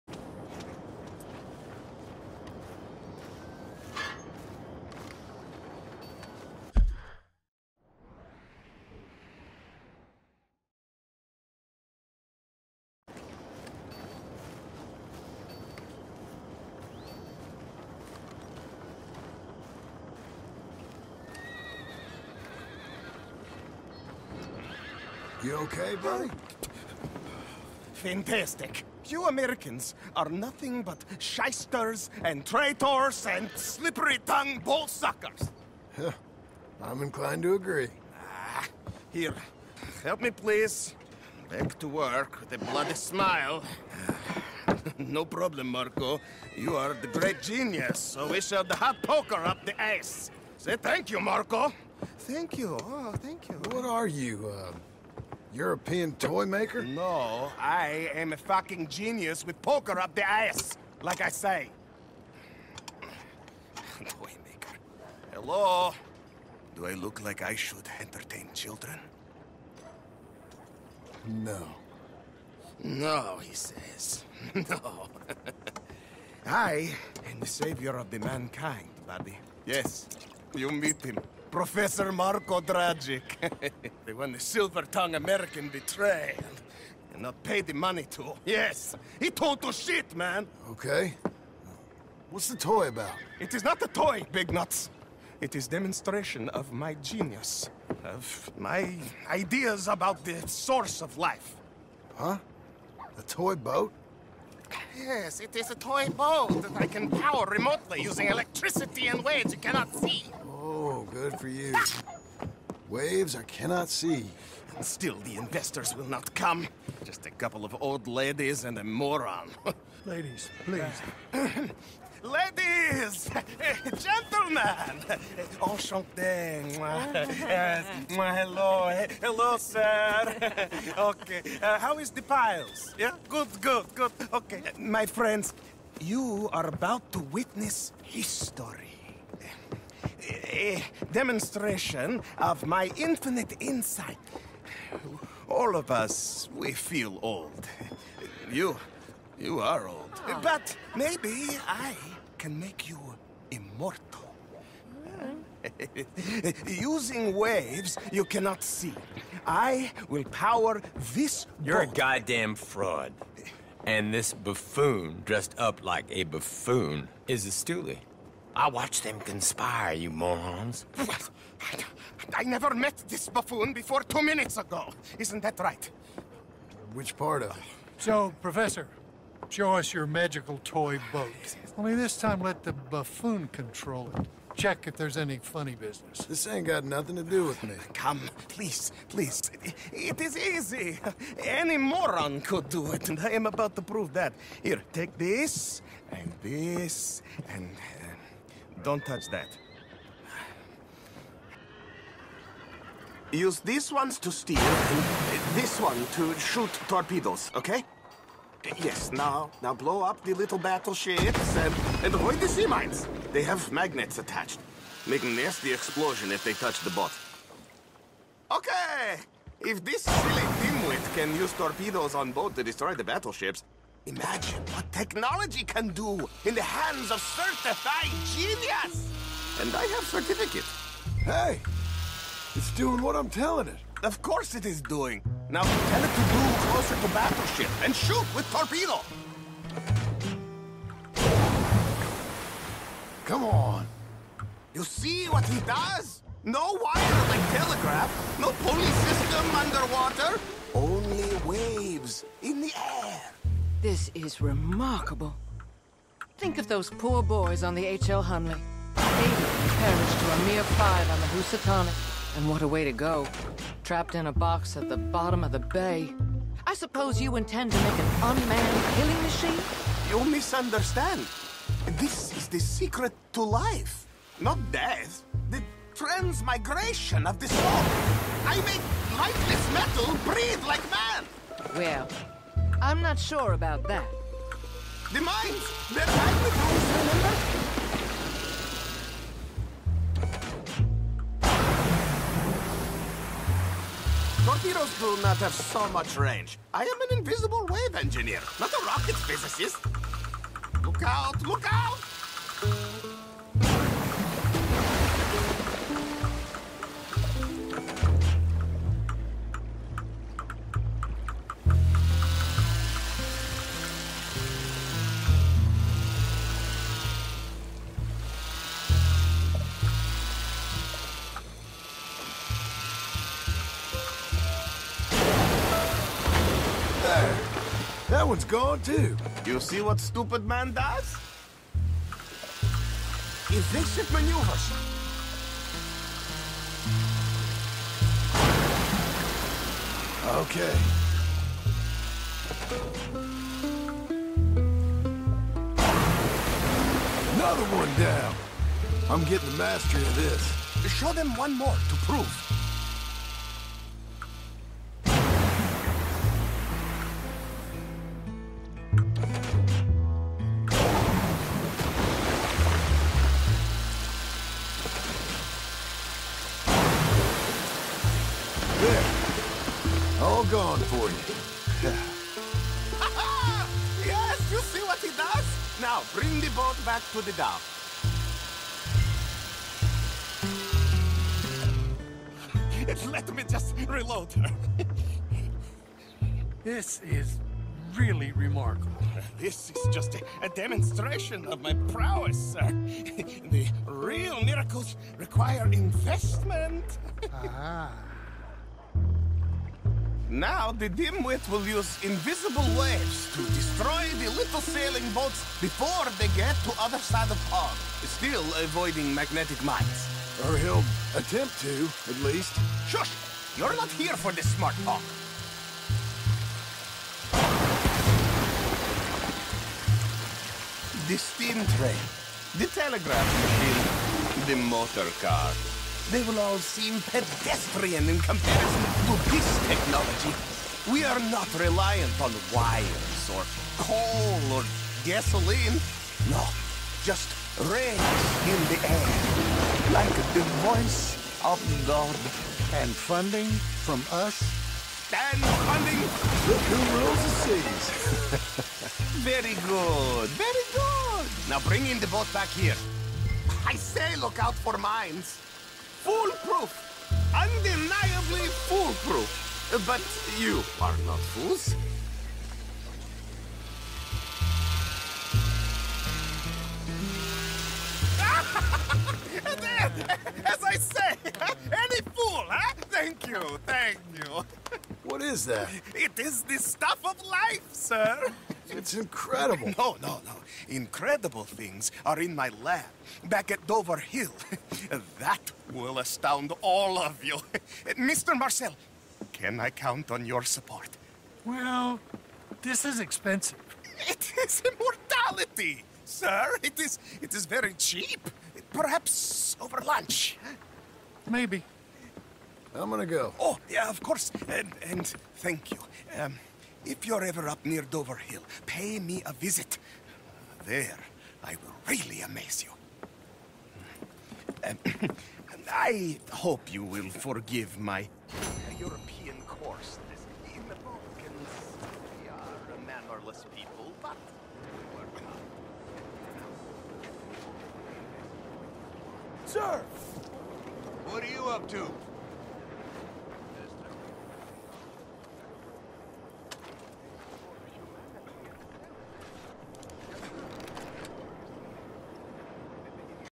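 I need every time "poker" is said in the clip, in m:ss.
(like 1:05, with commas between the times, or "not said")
0:49, 0:59.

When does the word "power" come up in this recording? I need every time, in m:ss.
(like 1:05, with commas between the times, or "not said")
1:47, 2:40.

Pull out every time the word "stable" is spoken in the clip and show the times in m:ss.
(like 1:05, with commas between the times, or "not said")
not said.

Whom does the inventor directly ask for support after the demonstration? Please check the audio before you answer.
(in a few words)
Mr. Marcel.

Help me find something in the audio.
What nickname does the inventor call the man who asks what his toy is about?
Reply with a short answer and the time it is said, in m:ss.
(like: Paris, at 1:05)
Big Nuts, at 1:34.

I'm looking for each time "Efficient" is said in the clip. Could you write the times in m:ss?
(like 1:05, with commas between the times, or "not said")
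5:33.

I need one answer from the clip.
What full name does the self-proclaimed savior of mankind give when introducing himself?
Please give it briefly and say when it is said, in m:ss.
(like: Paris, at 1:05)
Professor Marko Dragic, at 1:21.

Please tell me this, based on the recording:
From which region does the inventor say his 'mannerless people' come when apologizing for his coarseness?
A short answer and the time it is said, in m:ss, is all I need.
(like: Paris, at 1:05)
the Balkans, at 8:40.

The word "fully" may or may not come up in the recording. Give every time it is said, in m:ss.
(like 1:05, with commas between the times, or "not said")
not said.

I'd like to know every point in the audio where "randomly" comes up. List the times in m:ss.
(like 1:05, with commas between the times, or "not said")
not said.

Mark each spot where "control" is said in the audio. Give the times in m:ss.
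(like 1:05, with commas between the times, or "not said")
3:03.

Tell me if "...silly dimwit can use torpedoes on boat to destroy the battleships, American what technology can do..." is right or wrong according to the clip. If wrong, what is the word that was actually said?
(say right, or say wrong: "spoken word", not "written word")
wrong: "Imagine", not "American".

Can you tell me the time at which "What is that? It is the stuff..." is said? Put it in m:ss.
7:55.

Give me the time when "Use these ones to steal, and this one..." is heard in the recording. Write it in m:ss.
3:23.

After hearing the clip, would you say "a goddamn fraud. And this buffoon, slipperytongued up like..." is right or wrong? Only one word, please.
wrong.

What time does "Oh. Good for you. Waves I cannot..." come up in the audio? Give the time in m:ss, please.
1:50.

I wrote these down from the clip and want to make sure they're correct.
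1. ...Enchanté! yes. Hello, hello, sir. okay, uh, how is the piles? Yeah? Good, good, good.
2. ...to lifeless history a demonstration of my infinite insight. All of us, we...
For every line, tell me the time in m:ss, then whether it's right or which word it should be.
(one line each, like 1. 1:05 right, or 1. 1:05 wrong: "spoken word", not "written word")
1. 2:05 right
2. 2:17 wrong: "witness", not "lifeless".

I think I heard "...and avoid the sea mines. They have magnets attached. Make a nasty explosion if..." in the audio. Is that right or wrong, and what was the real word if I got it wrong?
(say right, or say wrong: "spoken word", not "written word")
right.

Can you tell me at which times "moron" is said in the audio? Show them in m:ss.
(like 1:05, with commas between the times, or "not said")
1:58, 2:50, 3:11.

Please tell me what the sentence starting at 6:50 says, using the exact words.
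Or he'll attempt to, at least.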